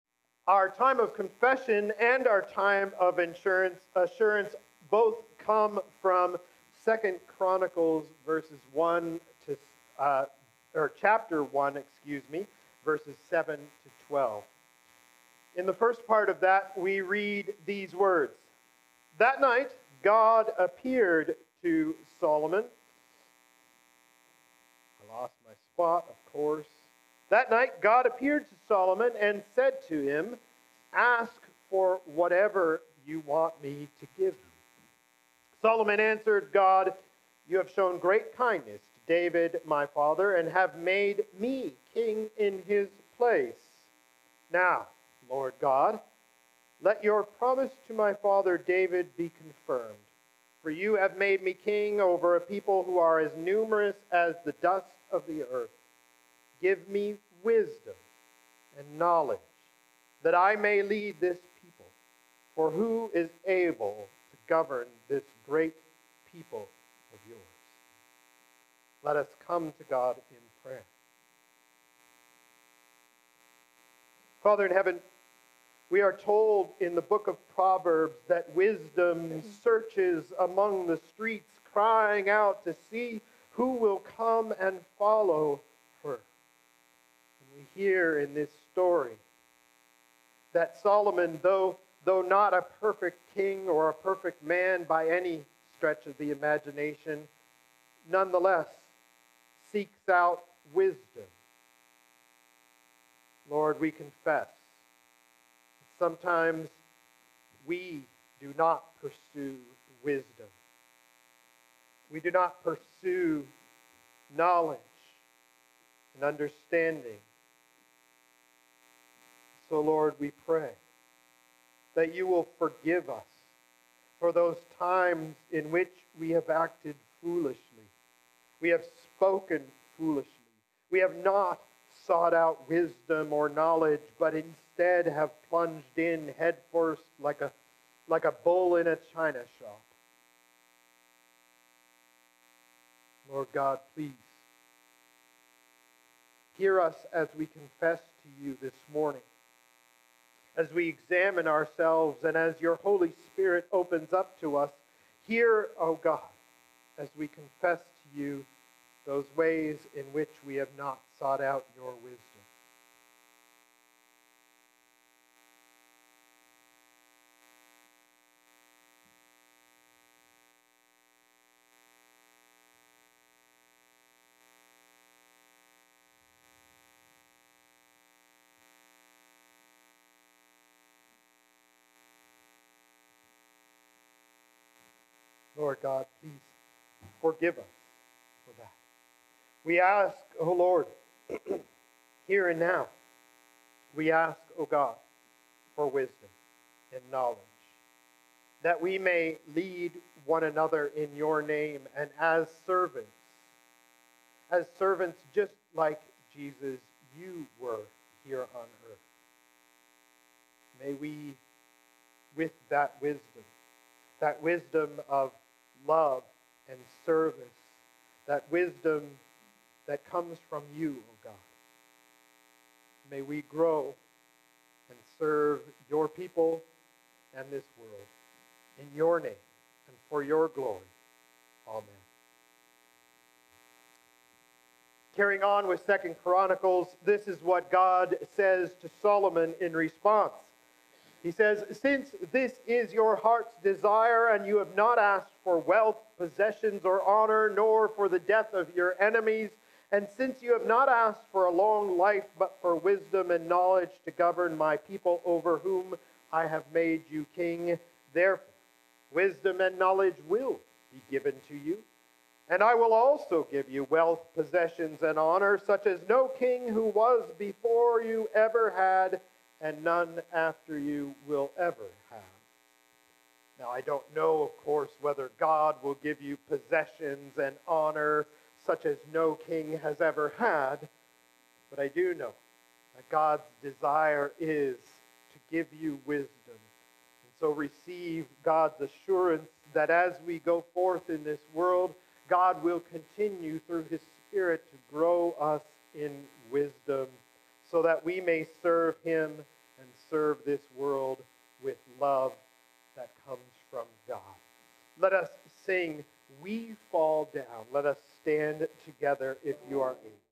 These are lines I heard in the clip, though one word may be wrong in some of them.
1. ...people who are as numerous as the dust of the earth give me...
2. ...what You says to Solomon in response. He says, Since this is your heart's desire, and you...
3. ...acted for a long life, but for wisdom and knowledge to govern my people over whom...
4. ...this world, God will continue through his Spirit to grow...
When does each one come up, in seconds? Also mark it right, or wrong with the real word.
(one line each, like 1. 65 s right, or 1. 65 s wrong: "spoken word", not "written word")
1. 52 s right
2. 237 s wrong: "God", not "You"
3. 250 s wrong: "asked", not "acted"
4. 291 s right.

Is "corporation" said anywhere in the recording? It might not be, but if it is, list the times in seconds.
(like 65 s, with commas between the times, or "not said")
not said.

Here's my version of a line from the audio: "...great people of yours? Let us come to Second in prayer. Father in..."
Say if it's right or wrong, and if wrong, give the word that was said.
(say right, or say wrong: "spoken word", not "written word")
wrong: "God", not "Second".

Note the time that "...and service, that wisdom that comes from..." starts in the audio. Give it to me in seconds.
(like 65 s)
216 s.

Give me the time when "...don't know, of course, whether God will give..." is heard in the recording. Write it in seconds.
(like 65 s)
273 s.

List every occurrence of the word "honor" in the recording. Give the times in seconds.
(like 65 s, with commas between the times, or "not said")
247 s, 265 s, 277 s.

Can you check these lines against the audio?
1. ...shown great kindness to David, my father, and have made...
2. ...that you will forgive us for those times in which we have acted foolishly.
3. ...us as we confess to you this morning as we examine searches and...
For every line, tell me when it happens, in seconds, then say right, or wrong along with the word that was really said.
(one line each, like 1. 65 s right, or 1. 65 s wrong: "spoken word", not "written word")
1. 37 s right
2. 121 s right
3. 146 s wrong: "ourselves", not "searches".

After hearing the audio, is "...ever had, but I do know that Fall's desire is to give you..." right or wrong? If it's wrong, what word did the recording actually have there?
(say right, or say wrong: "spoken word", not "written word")
wrong: "God", not "Fall".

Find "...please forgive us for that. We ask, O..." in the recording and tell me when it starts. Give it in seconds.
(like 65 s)
186 s.